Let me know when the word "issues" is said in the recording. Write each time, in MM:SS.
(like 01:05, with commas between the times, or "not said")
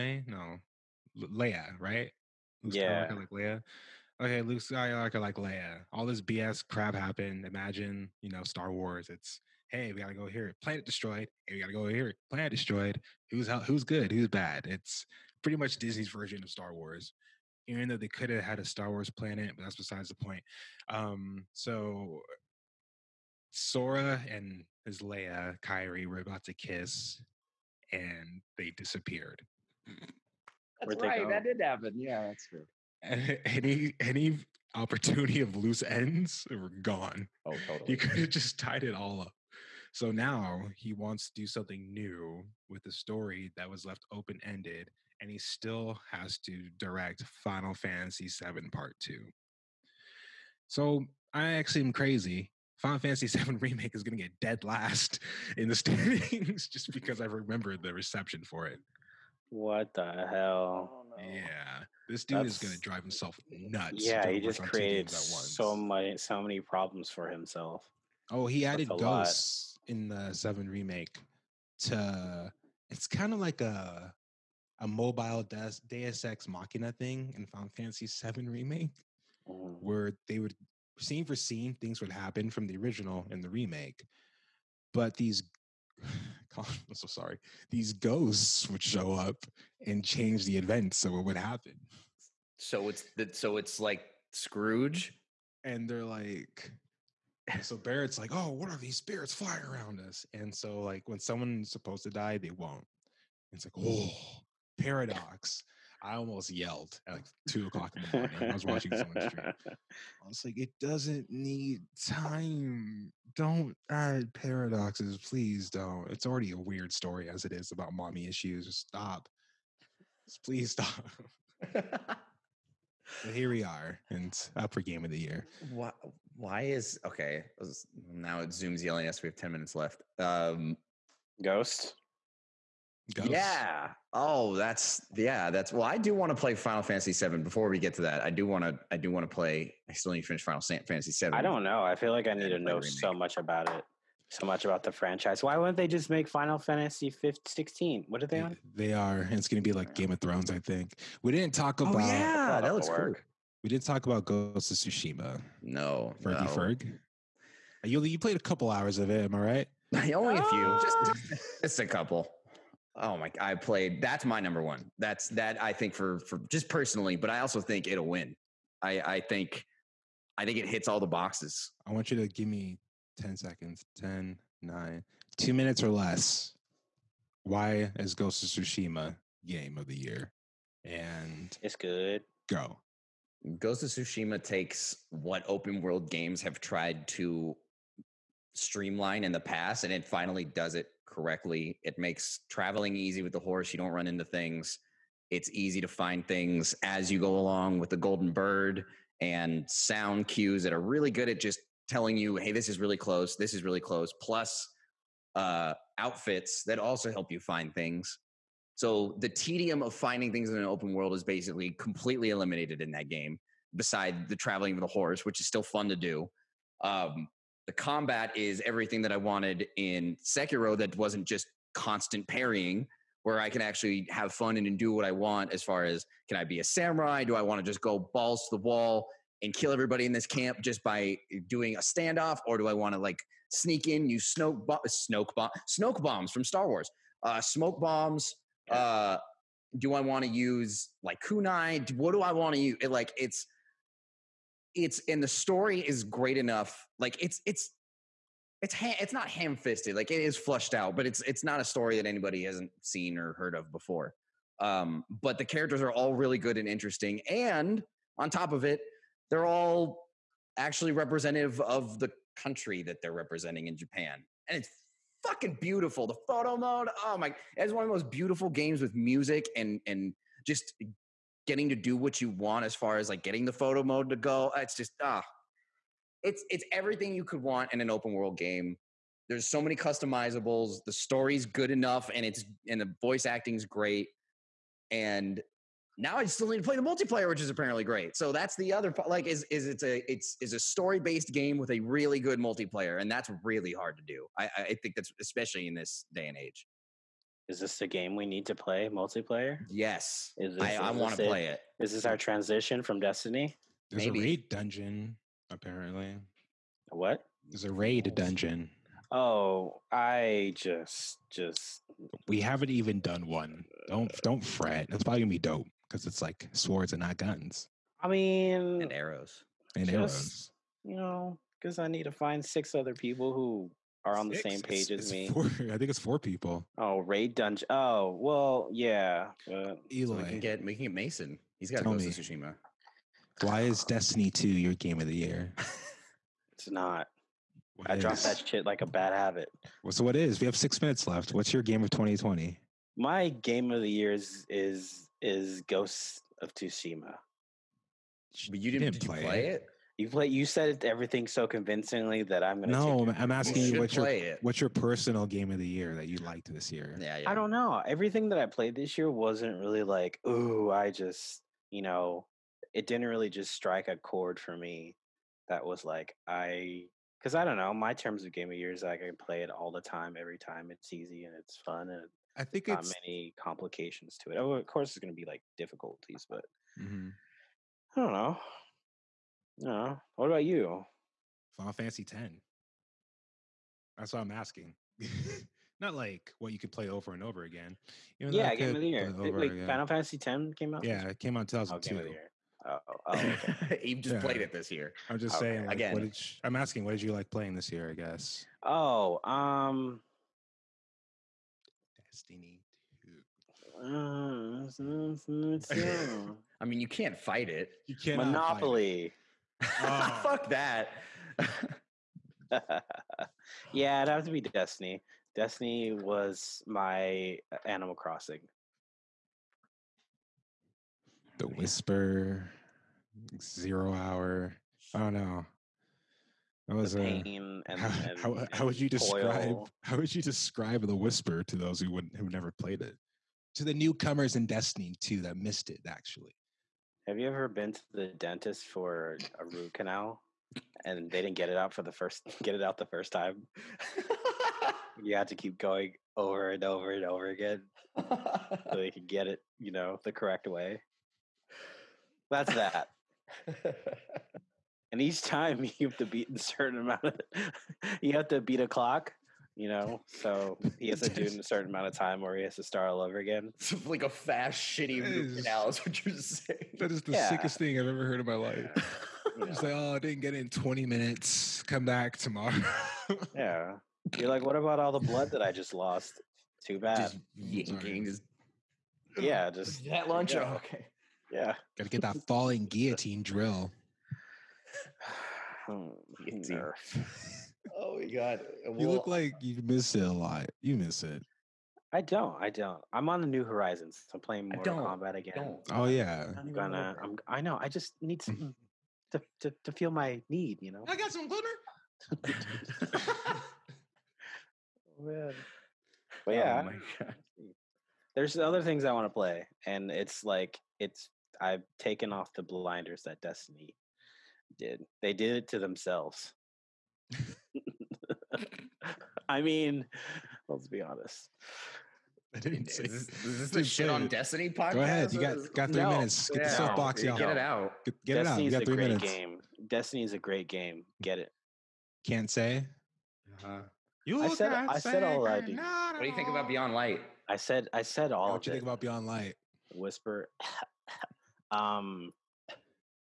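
01:58.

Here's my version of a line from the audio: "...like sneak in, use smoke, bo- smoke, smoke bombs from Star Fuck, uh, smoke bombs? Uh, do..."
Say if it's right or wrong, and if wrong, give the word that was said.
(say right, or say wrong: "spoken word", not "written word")
wrong: "Wars", not "Fuck".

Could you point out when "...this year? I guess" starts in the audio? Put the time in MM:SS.
06:37.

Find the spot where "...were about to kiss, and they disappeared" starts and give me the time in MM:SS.
00:26.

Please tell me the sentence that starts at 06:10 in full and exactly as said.
It's easy and it's fun and I think not it's, many complications to it.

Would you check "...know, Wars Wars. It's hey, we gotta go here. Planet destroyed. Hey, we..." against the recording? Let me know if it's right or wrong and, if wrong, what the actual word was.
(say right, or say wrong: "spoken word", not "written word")
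wrong: "Star", not "Wars".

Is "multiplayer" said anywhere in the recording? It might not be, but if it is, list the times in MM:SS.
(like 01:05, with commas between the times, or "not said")
04:46, 04:52, 04:58.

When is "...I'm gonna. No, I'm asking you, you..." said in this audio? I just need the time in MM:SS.
05:52.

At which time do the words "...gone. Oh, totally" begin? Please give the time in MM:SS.
00:36.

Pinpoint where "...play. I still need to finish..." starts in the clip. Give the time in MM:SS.
02:19.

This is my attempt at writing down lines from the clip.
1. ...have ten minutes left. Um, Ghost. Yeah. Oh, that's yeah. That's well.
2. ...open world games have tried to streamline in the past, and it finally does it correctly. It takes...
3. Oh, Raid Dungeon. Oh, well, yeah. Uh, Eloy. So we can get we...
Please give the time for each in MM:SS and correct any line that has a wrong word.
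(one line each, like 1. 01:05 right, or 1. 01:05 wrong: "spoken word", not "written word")
1. 02:09 right
2. 03:05 wrong: "makes", not "takes"
3. 05:26 right.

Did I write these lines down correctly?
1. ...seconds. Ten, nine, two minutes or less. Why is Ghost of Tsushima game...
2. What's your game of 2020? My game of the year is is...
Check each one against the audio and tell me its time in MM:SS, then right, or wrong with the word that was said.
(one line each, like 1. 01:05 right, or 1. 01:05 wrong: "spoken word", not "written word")
1. 02:53 right
2. 05:41 right.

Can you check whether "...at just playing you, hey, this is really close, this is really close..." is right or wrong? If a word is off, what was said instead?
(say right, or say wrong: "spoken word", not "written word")
wrong: "telling", not "playing".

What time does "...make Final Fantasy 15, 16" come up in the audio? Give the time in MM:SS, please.
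02:26.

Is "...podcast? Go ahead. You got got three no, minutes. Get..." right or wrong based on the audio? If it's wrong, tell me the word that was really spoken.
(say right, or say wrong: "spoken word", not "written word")
right.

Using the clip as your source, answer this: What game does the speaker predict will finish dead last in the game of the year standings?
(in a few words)
Final Fantasy VII Remake.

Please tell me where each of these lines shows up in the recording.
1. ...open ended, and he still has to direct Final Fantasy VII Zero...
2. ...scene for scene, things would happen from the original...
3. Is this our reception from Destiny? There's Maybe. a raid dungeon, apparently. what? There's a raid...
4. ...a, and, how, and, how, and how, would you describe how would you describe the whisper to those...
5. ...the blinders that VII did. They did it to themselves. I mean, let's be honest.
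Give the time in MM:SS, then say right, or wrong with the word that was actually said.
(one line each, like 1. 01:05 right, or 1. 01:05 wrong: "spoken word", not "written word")
1. 00:44 wrong: "Part", not "Zero"
2. 01:20 right
3. 05:01 wrong: "transition", not "reception"
4. 07:06 right
5. 08:32 wrong: "Destiny", not "VII".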